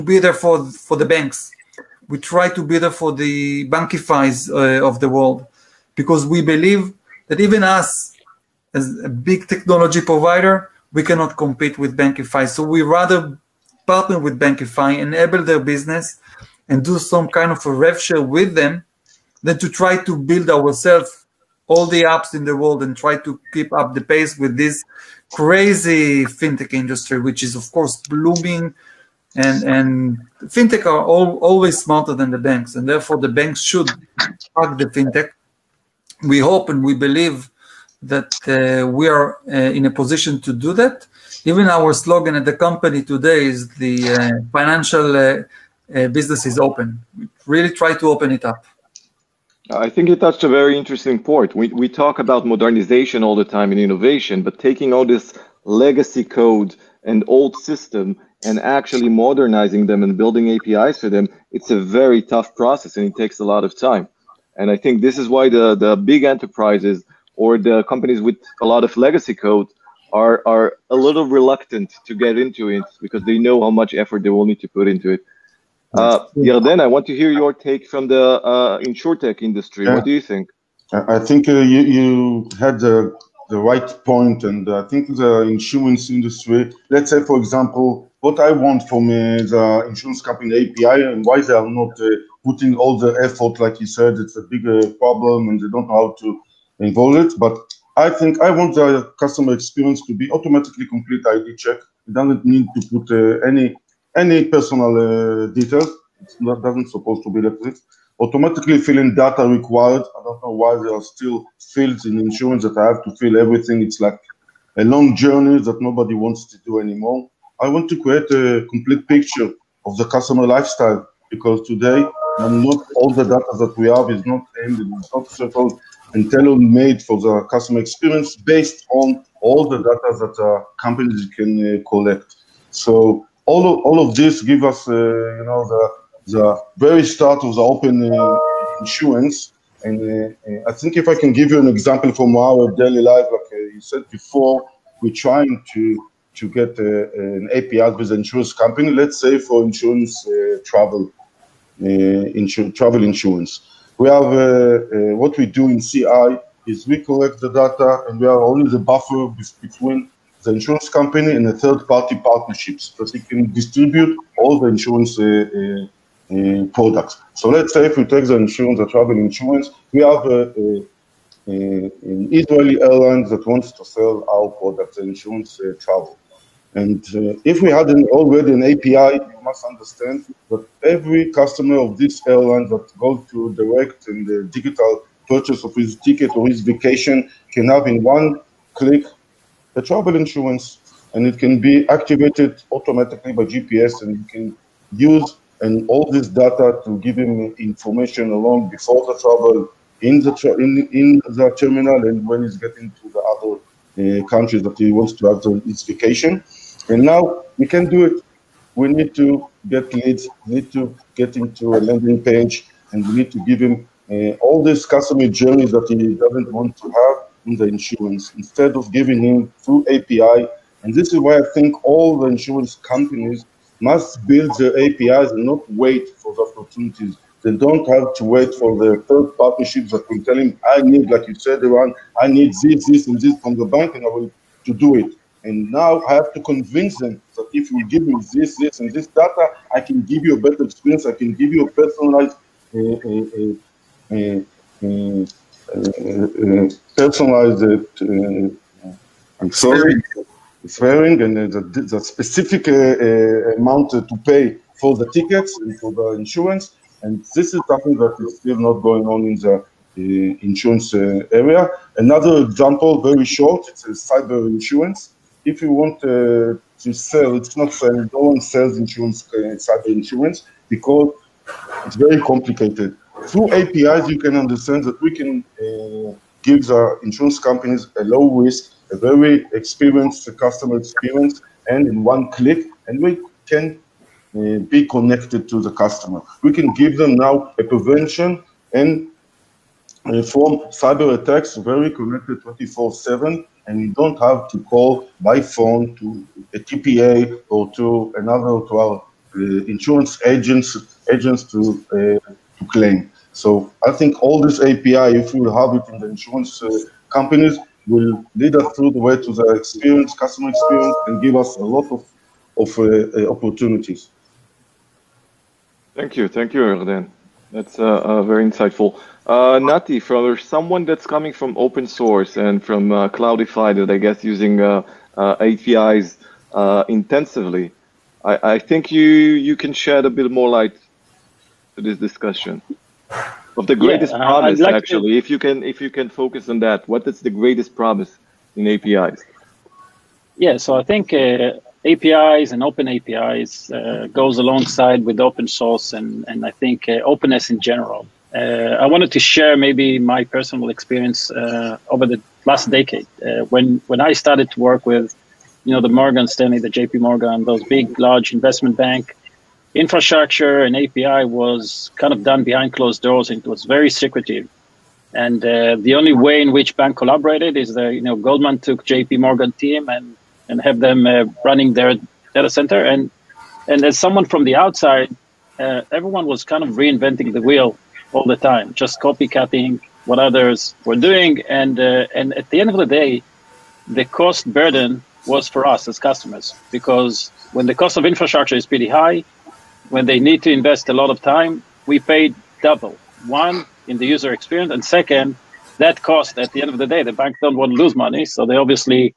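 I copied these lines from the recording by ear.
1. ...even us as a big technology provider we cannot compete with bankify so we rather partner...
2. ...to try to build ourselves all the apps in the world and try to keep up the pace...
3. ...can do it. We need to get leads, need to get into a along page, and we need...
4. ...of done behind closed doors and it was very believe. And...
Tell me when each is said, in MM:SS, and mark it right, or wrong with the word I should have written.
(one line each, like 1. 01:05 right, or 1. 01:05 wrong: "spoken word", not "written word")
1. 00:07 right
2. 00:19 right
3. 03:27 wrong: "landing", not "along"
4. 06:02 wrong: "secretive", not "believe".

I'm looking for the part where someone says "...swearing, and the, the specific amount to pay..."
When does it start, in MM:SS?
04:10.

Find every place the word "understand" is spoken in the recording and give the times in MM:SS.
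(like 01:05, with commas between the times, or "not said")
02:59, 04:34.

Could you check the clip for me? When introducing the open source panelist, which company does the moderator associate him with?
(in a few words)
Cloudify.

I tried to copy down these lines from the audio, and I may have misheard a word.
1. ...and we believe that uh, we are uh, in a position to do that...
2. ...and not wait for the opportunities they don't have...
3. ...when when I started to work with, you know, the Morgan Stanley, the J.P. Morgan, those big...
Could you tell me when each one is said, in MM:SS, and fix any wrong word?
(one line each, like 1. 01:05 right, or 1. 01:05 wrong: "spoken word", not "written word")
1. 00:36 right
2. 03:45 right
3. 05:53 right.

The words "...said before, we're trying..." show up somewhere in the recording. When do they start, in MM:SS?
02:23.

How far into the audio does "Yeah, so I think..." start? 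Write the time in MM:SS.
05:40.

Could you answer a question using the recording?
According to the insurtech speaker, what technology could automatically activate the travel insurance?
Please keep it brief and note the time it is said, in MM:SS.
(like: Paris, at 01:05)
GPS, at 03:13.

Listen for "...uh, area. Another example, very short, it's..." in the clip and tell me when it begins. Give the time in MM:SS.
04:20.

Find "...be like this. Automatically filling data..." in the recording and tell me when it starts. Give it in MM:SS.
01:47.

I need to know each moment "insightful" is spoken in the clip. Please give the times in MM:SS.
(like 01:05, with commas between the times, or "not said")
05:18.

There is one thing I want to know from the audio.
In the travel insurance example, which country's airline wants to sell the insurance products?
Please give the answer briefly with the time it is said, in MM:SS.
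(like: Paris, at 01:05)
Israeli, at 02:52.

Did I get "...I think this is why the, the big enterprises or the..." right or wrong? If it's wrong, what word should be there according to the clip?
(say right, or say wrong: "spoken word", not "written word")
right.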